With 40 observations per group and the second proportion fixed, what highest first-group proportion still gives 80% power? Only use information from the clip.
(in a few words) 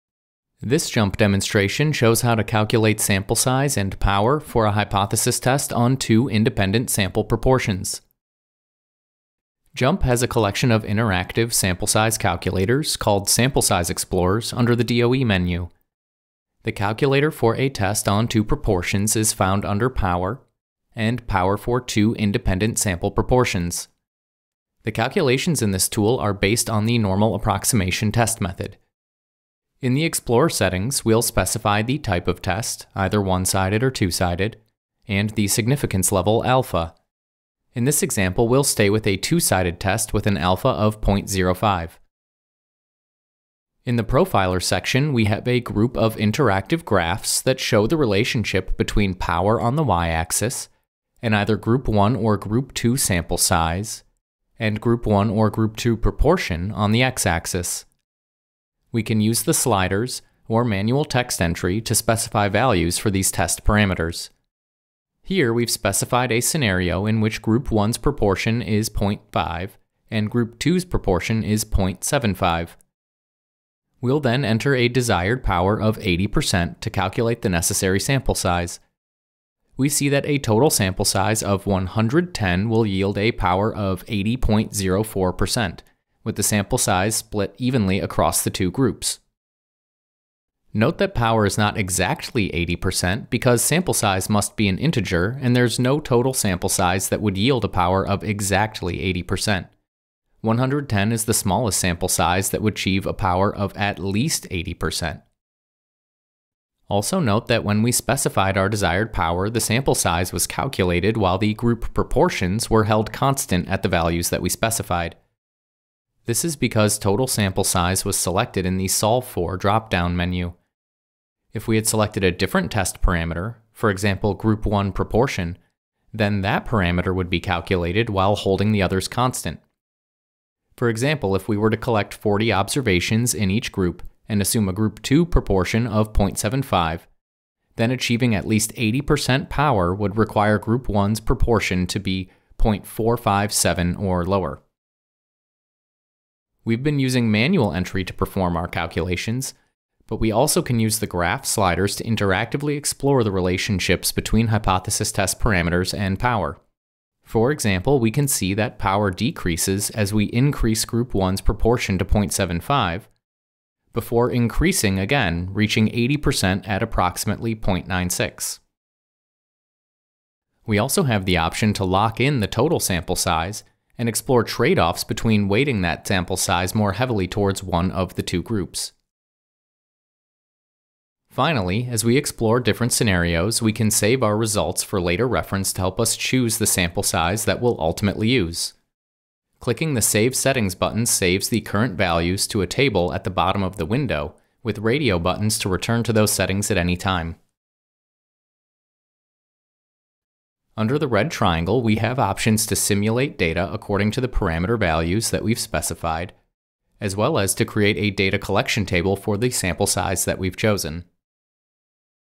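0.457.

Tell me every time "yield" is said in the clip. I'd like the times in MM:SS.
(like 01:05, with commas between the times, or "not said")
01:22, 01:37.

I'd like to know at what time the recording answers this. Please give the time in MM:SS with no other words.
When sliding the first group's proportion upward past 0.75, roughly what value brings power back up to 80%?
02:47.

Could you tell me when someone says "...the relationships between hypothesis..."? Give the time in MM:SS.
02:33.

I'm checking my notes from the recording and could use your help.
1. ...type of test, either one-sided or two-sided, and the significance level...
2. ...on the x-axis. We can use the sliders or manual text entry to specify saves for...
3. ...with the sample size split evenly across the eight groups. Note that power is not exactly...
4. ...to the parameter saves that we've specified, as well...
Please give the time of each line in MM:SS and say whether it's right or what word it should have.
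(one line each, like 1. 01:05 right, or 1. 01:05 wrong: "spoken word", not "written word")
1. 00:31 right
2. 00:56 wrong: "values", not "saves"
3. 01:26 wrong: "two", not "eight"
4. 03:24 wrong: "values", not "saves".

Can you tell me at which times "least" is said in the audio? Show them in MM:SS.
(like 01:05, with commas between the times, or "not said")
01:43, 02:18.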